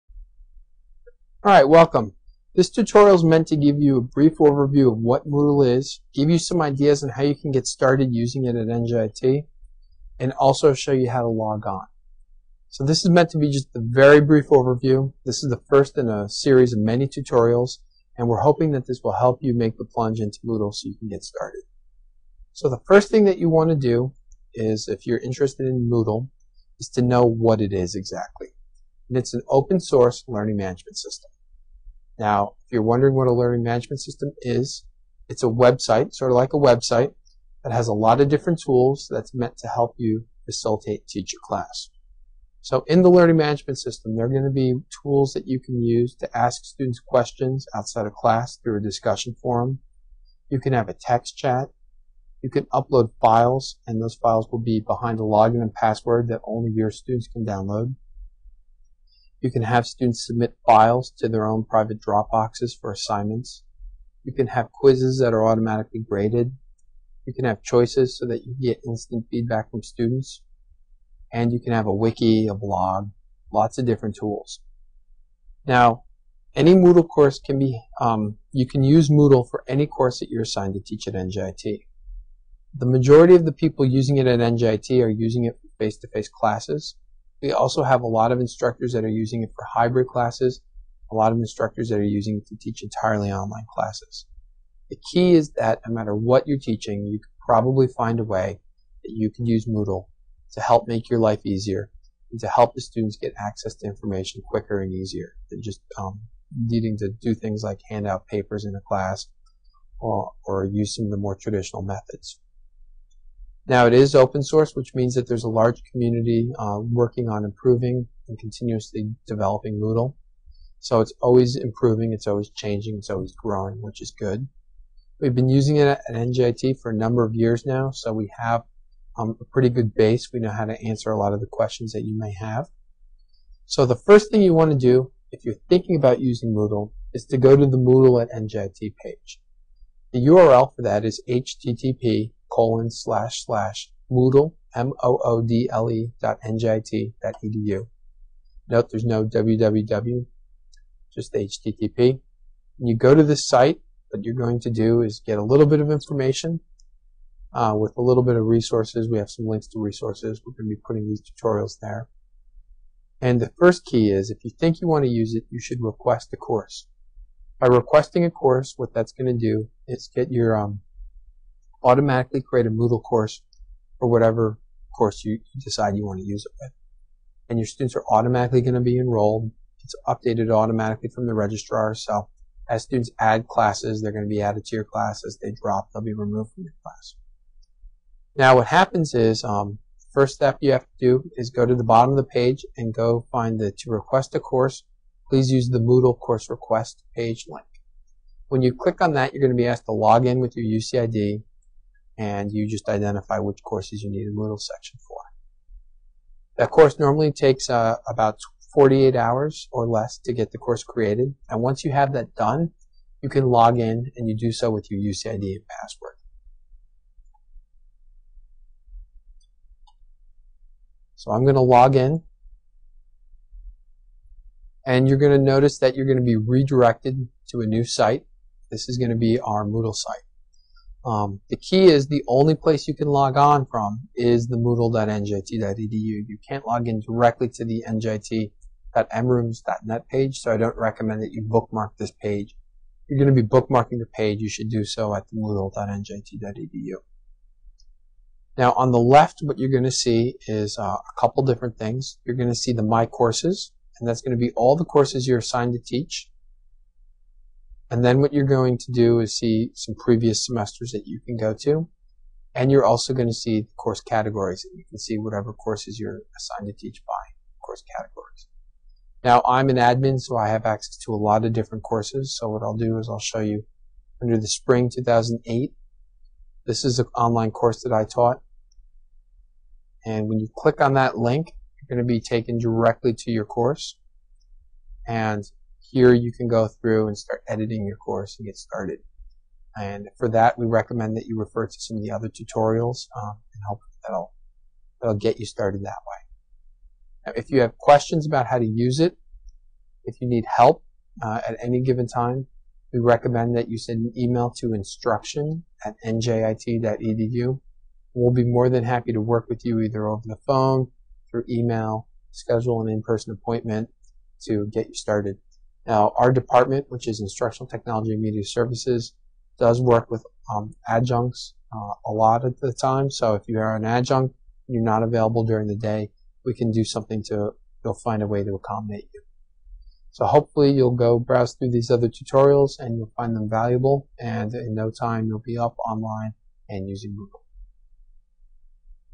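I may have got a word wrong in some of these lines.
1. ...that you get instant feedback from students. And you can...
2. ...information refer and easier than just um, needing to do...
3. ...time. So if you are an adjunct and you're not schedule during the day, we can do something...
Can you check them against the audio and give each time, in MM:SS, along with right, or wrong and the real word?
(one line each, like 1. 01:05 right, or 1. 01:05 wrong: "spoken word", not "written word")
1. 01:08 right
2. 01:43 wrong: "quicker", not "refer"
3. 05:22 wrong: "available", not "schedule".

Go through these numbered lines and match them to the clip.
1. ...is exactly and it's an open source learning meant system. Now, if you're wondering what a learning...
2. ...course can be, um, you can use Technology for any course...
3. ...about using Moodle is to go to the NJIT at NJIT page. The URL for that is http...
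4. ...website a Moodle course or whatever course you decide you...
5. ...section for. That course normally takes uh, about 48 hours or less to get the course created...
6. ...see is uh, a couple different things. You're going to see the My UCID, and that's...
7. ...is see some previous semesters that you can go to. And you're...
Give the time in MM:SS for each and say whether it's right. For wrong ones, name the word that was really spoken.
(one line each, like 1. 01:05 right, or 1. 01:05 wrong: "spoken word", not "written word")
1. 00:27 wrong: "management", not "meant"
2. 01:17 wrong: "Moodle", not "Technology"
3. 02:15 wrong: "Moodle", not "NJIT"
4. 02:52 wrong: "create", not "website"
5. 03:24 right
6. 04:09 wrong: "Courses", not "UCID"
7. 04:19 right.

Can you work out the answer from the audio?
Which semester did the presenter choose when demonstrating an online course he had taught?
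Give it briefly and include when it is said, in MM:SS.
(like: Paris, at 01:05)
Spring 2008, at 04:34.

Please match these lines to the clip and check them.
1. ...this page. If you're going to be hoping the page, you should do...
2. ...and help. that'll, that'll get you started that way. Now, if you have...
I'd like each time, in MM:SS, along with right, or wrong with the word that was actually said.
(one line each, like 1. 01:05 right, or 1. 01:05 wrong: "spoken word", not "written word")
1. 04:01 wrong: "bookmarking", not "hoping"
2. 04:53 right.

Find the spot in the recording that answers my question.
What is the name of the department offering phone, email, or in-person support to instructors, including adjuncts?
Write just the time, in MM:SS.
05:17.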